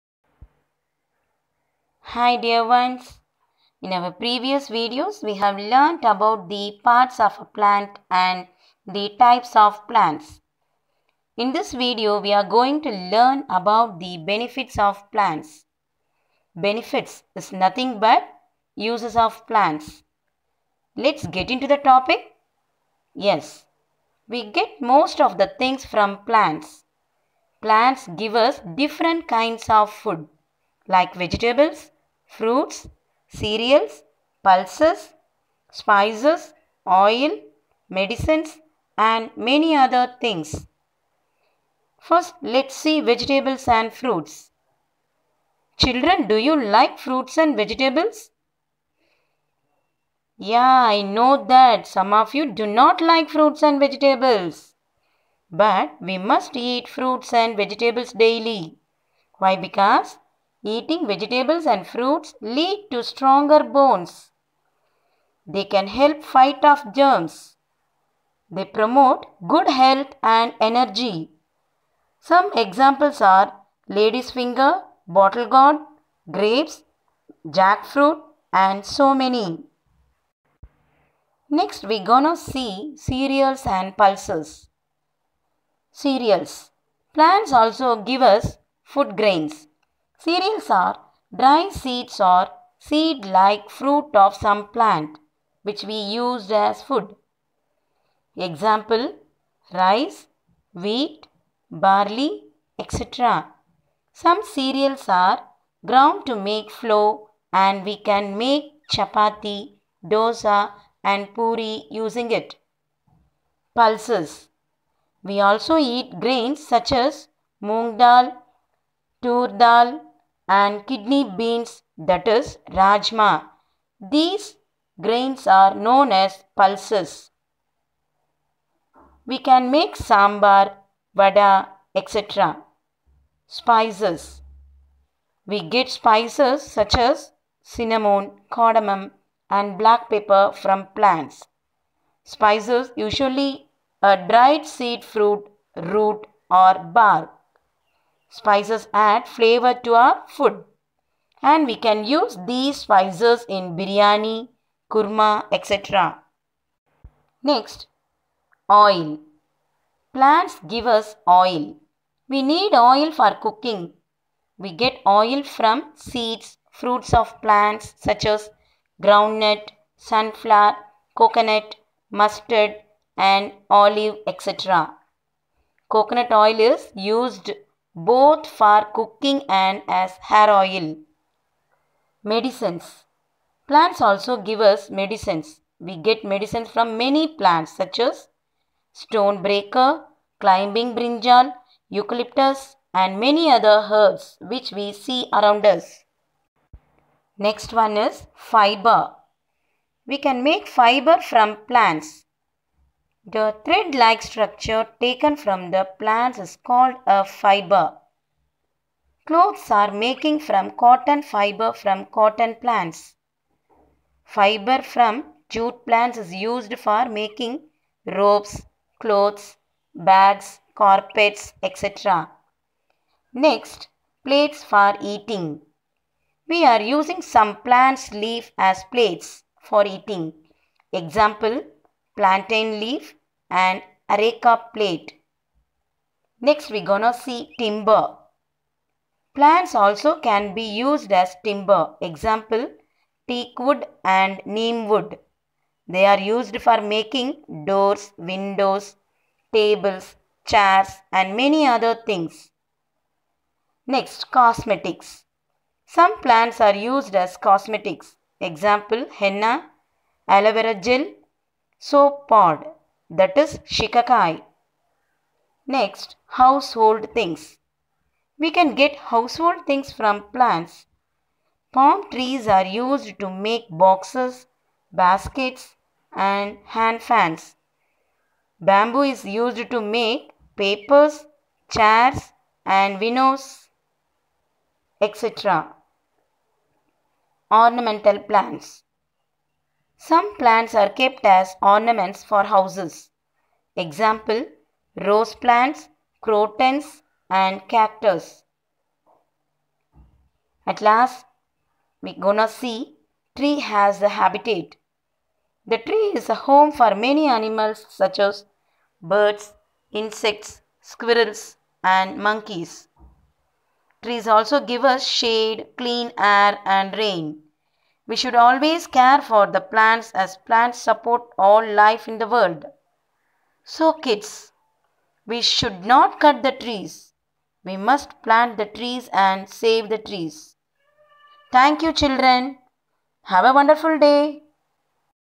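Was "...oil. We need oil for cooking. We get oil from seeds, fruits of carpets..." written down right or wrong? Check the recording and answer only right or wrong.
wrong.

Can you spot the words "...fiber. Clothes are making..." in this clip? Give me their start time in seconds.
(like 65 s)
207 s.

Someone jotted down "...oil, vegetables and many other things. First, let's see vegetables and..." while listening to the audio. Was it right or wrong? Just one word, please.
wrong.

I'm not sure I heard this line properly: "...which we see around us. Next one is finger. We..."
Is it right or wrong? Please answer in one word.
wrong.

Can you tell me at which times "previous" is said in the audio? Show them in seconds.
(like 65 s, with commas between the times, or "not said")
4 s.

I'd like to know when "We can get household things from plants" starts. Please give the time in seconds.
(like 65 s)
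268 s.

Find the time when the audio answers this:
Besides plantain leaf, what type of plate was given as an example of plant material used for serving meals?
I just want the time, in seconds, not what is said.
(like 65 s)
234 s.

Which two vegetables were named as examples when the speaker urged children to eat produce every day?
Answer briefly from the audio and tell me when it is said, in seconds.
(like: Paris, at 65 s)
lady's finger, bottle gourd, at 73 s.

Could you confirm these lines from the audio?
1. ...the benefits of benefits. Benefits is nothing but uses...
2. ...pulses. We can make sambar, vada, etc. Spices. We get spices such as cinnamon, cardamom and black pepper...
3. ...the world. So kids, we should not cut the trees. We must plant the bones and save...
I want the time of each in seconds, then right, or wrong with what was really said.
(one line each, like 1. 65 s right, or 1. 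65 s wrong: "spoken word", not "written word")
1. 14 s wrong: "plants", not "benefits"
2. 126 s right
3. 322 s wrong: "trees", not "bones".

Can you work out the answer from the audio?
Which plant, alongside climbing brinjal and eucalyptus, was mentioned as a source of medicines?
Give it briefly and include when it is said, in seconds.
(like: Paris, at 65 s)
stonebreaker, at 188 s.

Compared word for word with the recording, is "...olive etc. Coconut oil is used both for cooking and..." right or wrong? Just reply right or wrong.
right.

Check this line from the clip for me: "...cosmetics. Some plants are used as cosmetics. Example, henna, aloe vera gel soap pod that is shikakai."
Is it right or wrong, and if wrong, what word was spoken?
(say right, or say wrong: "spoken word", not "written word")
right.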